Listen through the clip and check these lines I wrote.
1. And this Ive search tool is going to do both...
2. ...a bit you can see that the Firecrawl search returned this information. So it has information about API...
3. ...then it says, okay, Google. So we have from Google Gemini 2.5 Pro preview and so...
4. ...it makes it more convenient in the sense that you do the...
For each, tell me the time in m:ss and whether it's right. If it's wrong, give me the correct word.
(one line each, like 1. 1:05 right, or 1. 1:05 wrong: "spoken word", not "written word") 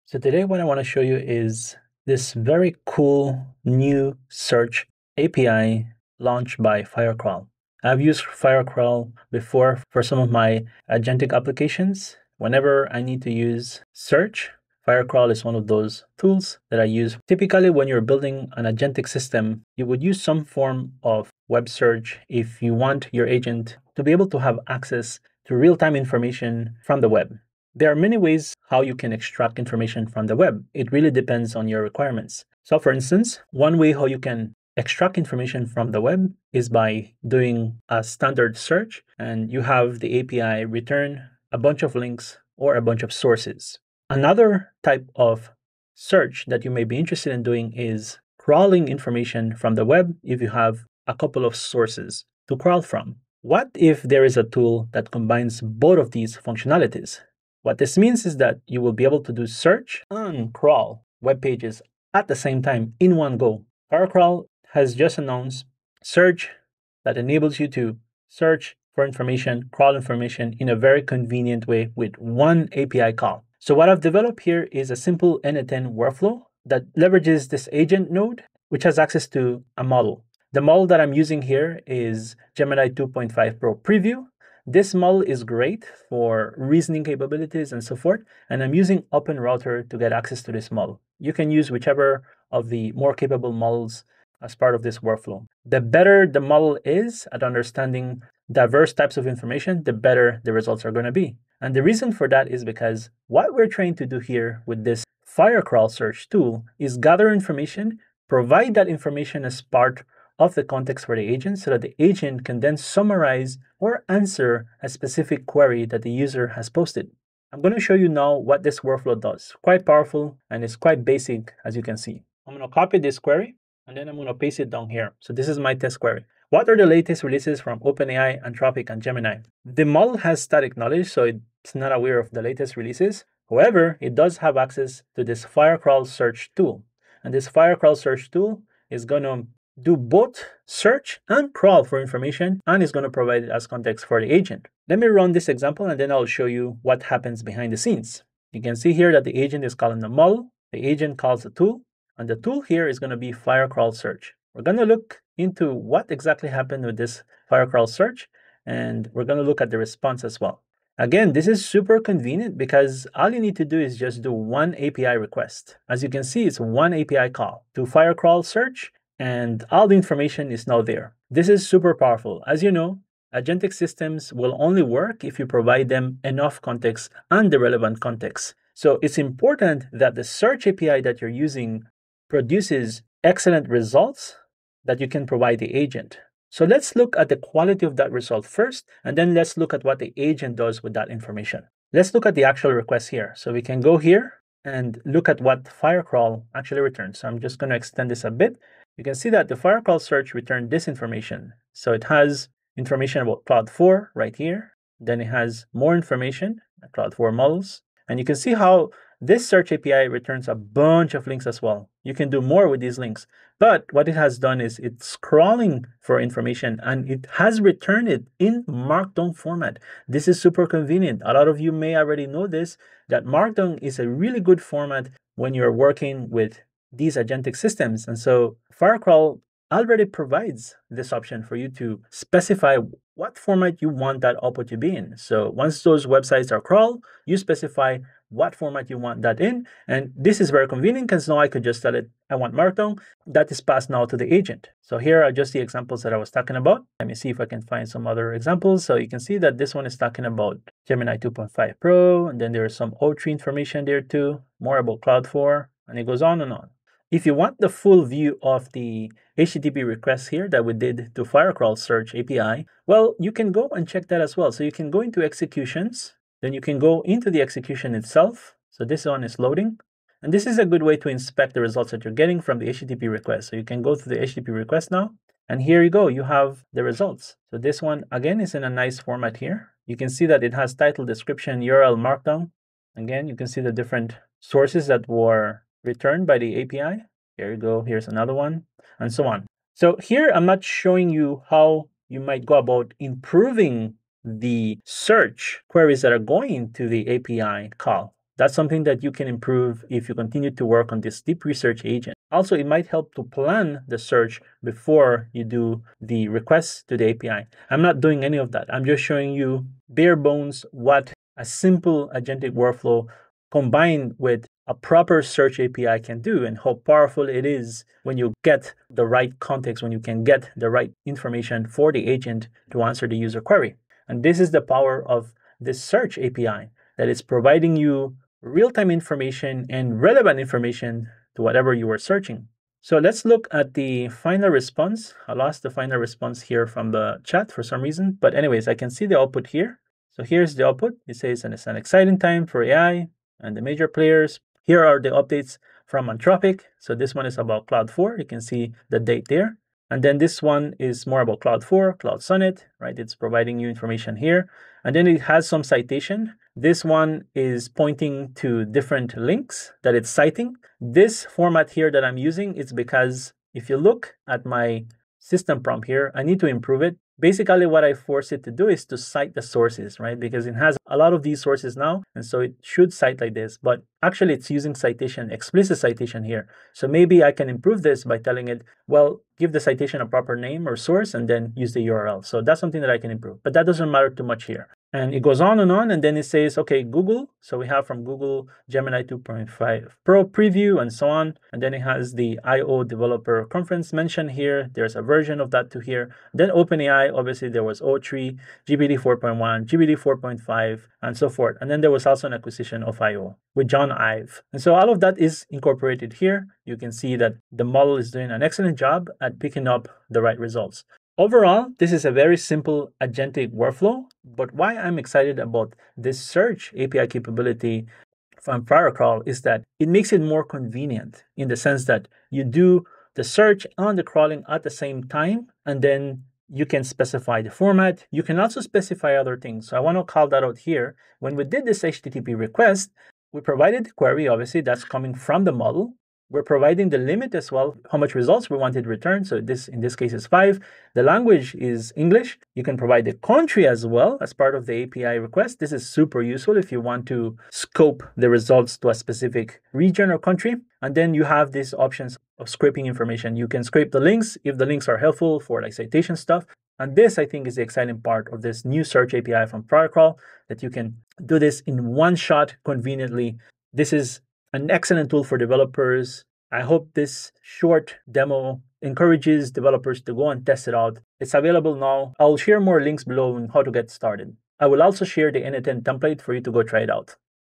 1. 2:17 wrong: "Firecrawl", not "Ive"
2. 3:18 wrong: "Claude", not "API"
3. 6:26 right
4. 6:59 right.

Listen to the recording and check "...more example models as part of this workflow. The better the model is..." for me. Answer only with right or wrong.
wrong.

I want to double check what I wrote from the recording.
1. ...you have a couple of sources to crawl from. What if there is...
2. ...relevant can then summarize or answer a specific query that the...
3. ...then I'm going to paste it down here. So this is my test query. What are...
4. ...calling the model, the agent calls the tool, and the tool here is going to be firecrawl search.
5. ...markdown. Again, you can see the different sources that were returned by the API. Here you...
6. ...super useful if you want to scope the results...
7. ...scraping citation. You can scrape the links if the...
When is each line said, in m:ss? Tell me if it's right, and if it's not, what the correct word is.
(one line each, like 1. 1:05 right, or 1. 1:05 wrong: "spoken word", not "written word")
1. 0:50 right
2. 1:51 wrong: "agent", not "relevant"
3. 2:03 right
4. 2:29 right
5. 4:42 right
6. 7:25 right
7. 7:32 wrong: "information", not "citation".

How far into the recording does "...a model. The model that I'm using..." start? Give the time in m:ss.
1:19.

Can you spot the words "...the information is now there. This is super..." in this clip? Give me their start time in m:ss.
2:49.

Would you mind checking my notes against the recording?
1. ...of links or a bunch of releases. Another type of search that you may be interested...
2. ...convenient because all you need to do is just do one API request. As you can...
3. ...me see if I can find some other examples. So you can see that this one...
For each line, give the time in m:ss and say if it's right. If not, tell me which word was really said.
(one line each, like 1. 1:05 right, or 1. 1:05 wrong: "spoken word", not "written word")
1. 0:41 wrong: "sources", not "releases"
2. 2:41 right
3. 4:07 right.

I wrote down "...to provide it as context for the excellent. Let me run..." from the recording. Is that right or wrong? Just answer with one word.
wrong.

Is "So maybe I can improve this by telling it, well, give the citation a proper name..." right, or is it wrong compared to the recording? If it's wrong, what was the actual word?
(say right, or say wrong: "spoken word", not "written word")
right.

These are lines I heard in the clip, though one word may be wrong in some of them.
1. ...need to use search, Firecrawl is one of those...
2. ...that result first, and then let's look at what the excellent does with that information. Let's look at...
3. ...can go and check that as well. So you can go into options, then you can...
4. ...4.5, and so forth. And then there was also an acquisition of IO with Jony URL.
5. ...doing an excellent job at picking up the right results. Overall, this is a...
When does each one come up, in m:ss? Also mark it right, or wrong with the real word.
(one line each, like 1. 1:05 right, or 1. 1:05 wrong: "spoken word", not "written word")
1. 0:13 right
2. 3:07 wrong: "agent", not "excellent"
3. 4:23 wrong: "executions", not "options"
4. 6:39 wrong: "Ive", not "URL"
5. 6:48 right.